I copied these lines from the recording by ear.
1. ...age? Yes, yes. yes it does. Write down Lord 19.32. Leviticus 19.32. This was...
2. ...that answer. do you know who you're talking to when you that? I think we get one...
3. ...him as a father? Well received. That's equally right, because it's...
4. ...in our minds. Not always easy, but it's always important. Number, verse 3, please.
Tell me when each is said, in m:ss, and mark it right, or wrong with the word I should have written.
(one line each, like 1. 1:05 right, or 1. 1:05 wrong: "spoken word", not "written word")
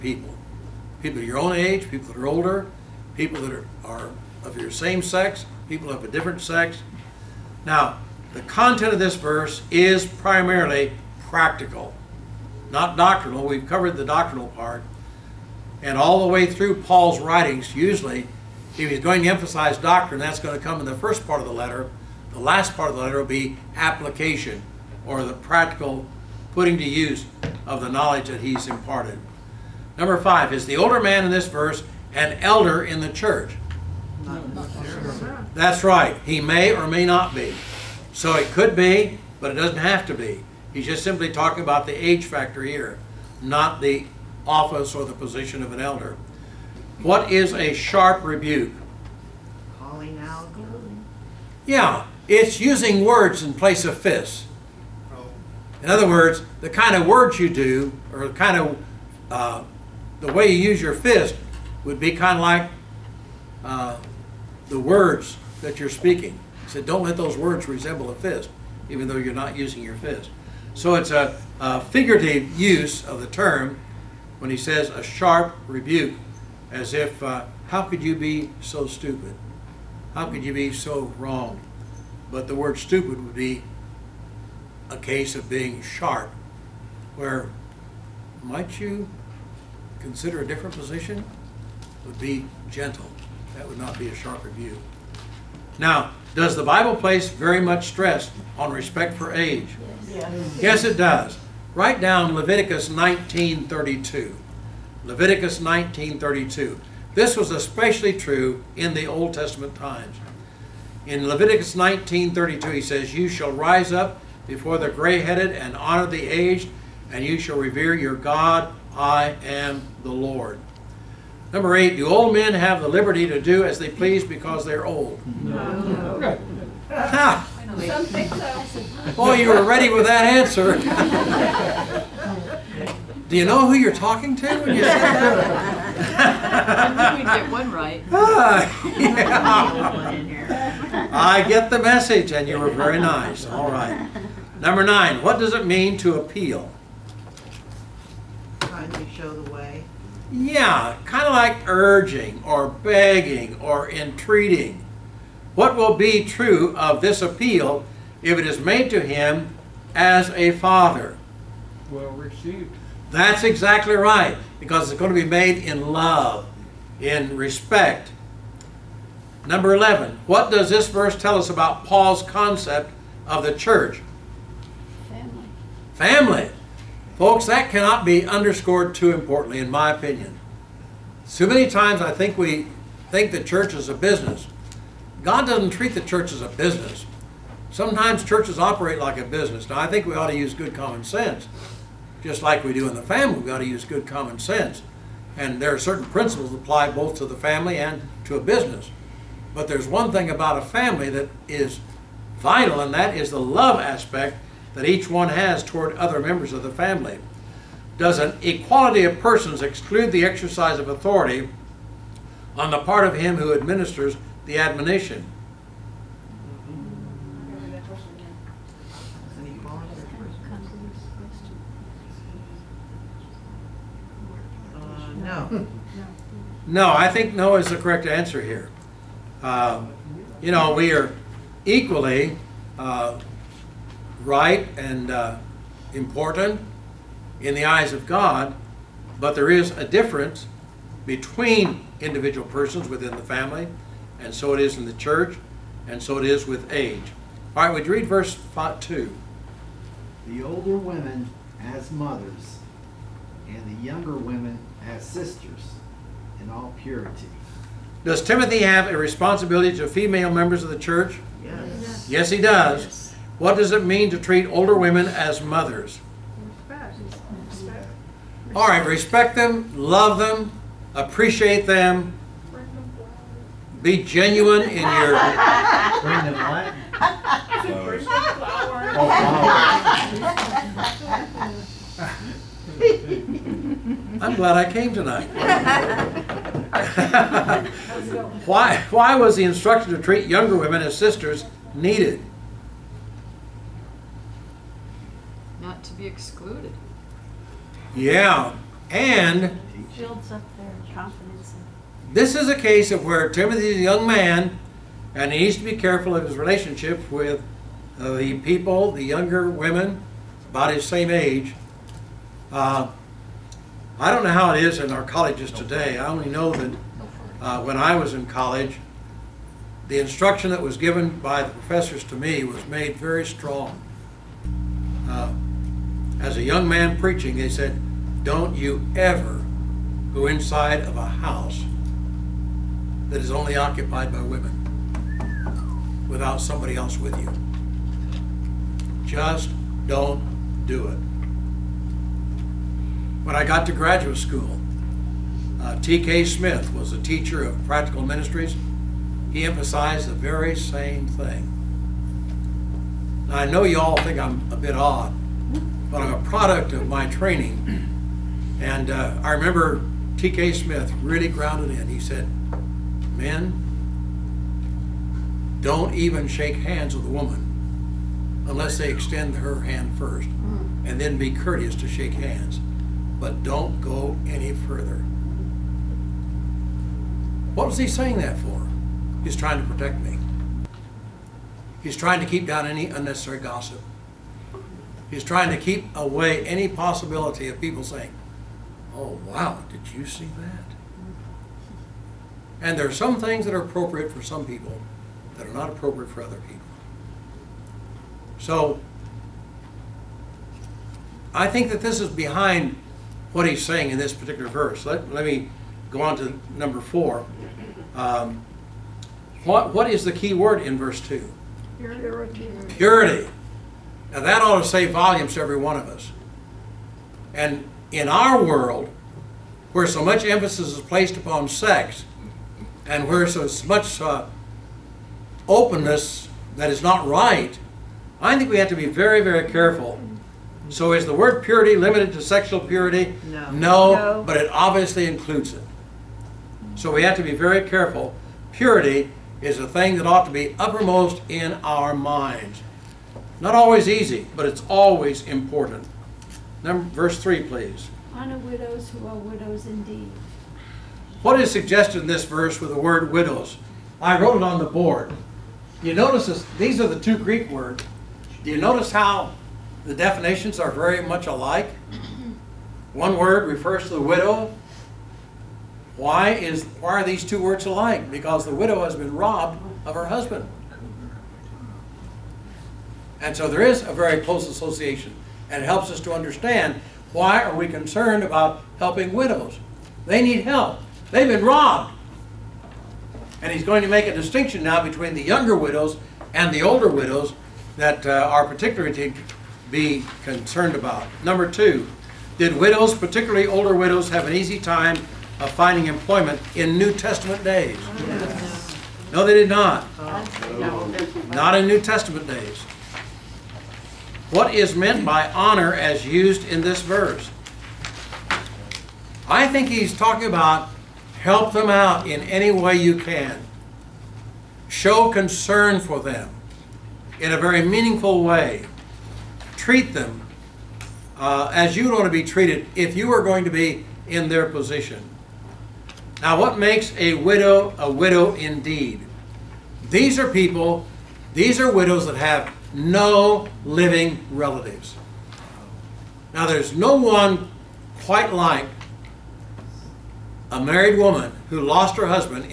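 1. 1:39 wrong: "Leviticus", not "Lord"
2. 2:10 right
3. 2:39 wrong: "exactly", not "equally"
4. 7:21 right.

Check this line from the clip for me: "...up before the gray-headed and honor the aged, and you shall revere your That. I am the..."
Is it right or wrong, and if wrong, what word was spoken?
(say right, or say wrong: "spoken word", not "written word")
wrong: "God", not "That".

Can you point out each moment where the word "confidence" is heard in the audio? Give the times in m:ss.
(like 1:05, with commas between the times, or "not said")
5:00.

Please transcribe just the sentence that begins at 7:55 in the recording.
And it helps us to understand why are we concerned about helping widows?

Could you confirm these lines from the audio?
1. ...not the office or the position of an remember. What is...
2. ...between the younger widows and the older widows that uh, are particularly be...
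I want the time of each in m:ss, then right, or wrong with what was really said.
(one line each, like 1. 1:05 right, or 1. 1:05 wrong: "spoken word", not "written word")
1. 0:43 wrong: "elder", not "remember"
2. 8:04 right.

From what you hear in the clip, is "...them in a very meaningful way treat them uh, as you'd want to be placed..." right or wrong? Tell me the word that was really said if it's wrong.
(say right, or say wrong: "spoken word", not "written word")
wrong: "treated", not "placed".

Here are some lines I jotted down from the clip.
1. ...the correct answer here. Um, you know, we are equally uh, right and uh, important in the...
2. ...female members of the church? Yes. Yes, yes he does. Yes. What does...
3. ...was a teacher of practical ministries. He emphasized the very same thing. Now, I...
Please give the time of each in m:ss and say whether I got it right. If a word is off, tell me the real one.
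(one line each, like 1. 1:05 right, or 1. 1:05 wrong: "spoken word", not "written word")
1. 3:47 right
2. 4:19 right
3. 5:46 right.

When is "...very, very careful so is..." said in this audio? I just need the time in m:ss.
7:08.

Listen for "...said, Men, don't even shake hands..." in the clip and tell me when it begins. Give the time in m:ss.
6:02.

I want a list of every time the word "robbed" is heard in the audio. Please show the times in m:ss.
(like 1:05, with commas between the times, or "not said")
7:49, 8:01.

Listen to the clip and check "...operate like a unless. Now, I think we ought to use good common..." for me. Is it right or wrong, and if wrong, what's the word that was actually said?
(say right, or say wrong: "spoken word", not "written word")
wrong: "business", not "unless".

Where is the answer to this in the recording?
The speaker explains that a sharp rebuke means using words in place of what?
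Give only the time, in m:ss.
0:53.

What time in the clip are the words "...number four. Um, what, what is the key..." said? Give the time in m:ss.
6:46.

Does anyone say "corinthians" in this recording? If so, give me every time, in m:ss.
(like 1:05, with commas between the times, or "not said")
not said.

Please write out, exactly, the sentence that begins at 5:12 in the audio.
Uh, I don't know how it is in our colleges today.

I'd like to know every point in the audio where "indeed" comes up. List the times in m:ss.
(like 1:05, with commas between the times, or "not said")
7:29, 8:48.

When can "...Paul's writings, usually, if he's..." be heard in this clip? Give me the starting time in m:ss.
0:16.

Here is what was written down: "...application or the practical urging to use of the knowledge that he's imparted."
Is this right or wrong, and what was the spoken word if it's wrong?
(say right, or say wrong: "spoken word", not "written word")
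wrong: "putting", not "urging".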